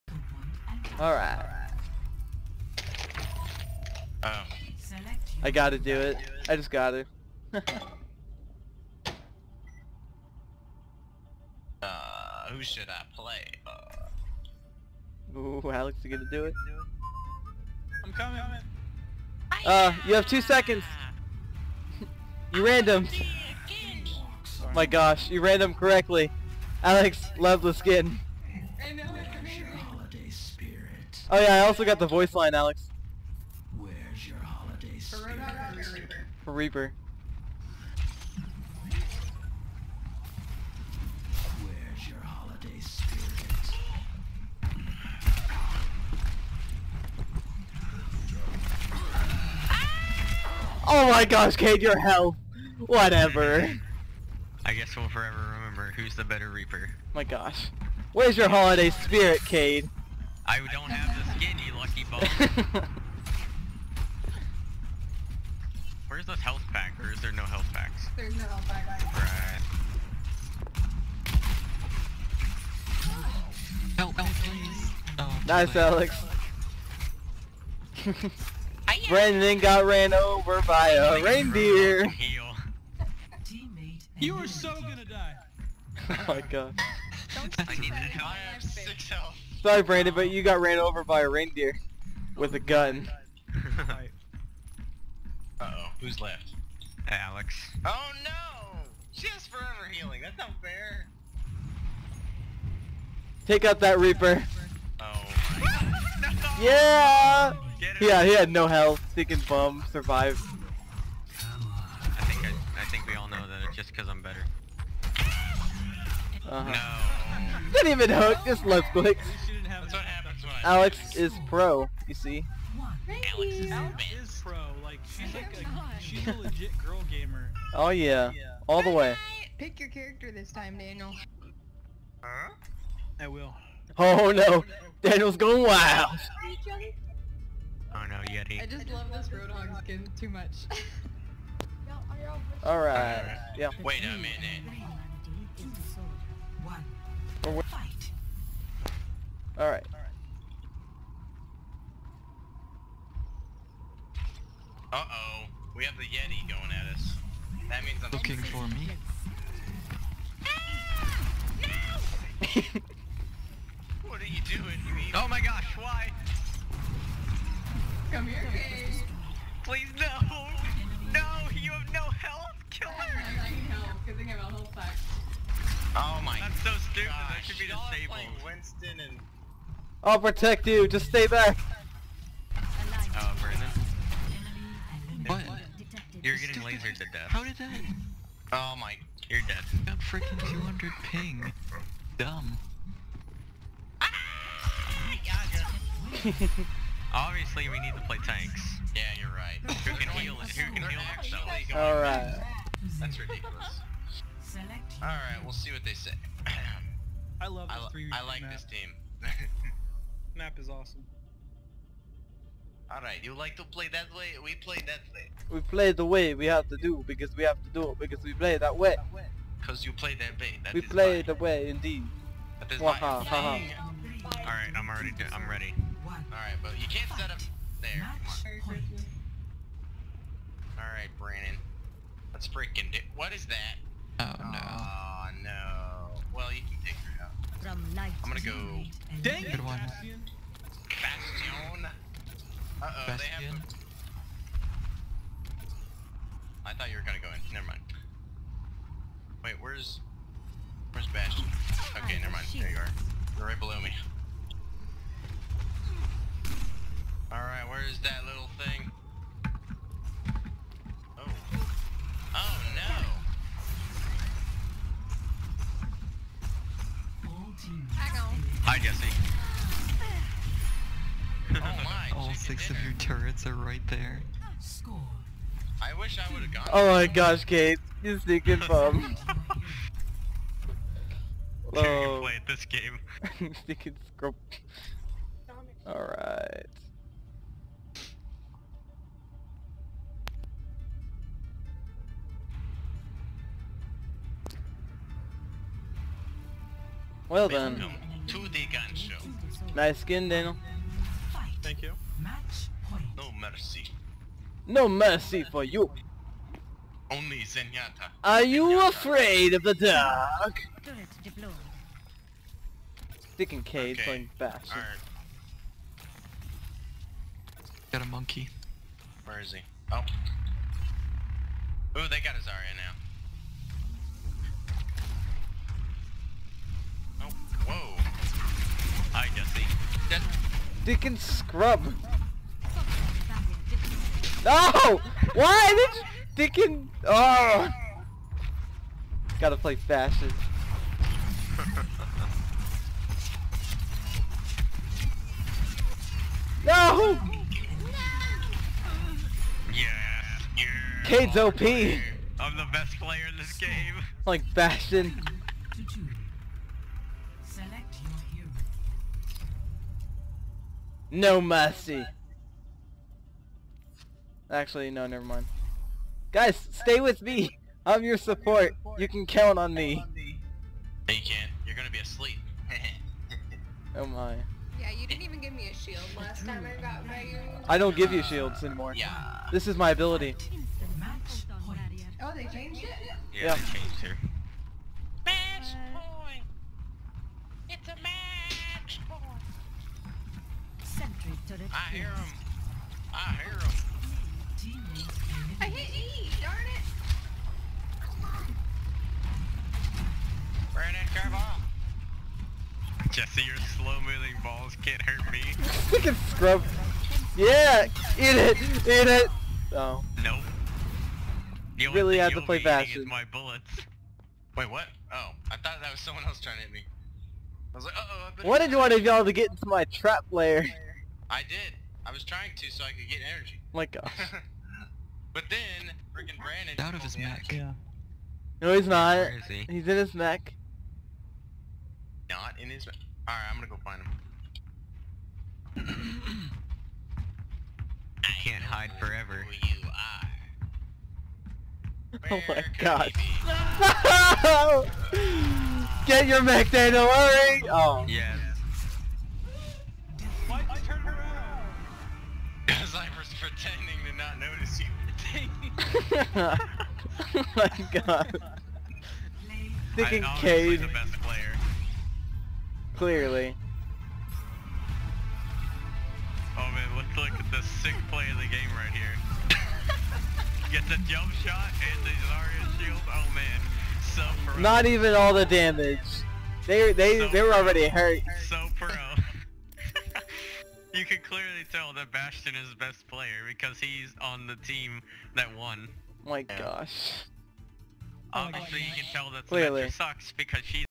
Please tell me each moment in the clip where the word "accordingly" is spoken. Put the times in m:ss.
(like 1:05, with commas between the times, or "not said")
not said.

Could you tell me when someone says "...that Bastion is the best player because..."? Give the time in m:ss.
8:01.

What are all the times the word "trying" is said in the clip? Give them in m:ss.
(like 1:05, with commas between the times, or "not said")
6:56, 7:02.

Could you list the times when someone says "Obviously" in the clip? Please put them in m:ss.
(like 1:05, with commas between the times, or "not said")
3:17, 8:08.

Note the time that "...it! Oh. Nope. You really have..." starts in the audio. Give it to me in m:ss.
6:49.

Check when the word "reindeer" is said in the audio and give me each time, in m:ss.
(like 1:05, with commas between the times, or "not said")
1:21, 1:31.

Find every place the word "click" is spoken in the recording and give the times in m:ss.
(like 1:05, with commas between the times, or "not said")
1:58.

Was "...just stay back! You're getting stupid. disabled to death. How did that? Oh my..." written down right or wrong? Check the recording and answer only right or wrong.
wrong.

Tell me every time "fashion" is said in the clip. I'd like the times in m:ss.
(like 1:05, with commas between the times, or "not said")
5:39.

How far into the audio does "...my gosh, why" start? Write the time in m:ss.
2:45.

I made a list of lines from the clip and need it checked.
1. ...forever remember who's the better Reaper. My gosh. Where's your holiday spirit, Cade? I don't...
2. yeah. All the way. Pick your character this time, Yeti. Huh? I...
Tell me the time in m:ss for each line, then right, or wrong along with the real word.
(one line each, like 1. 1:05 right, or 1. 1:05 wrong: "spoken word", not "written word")
1. 0:55 right
2. 2:08 wrong: "Daniel", not "Yeti".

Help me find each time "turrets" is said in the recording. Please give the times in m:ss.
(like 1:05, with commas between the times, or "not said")
4:32, 6:31.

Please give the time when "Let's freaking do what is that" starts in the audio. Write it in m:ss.
3:52.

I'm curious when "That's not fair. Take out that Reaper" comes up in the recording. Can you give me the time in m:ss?
1:40.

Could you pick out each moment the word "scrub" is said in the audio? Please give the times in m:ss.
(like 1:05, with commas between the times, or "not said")
5:31, 6:46.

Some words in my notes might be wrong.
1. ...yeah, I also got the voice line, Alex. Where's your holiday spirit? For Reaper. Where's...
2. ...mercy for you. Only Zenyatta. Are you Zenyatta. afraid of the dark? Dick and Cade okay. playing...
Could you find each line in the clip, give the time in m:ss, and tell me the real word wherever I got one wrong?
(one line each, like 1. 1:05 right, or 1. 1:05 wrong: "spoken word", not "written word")
1. 0:31 right
2. 5:04 right.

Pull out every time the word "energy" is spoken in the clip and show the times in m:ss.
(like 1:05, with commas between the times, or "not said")
7:03.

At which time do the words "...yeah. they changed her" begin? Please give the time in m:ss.
6:23.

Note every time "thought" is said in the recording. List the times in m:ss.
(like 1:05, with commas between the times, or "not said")
4:06, 6:55.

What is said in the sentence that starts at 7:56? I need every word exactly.
They they so they were already hurt.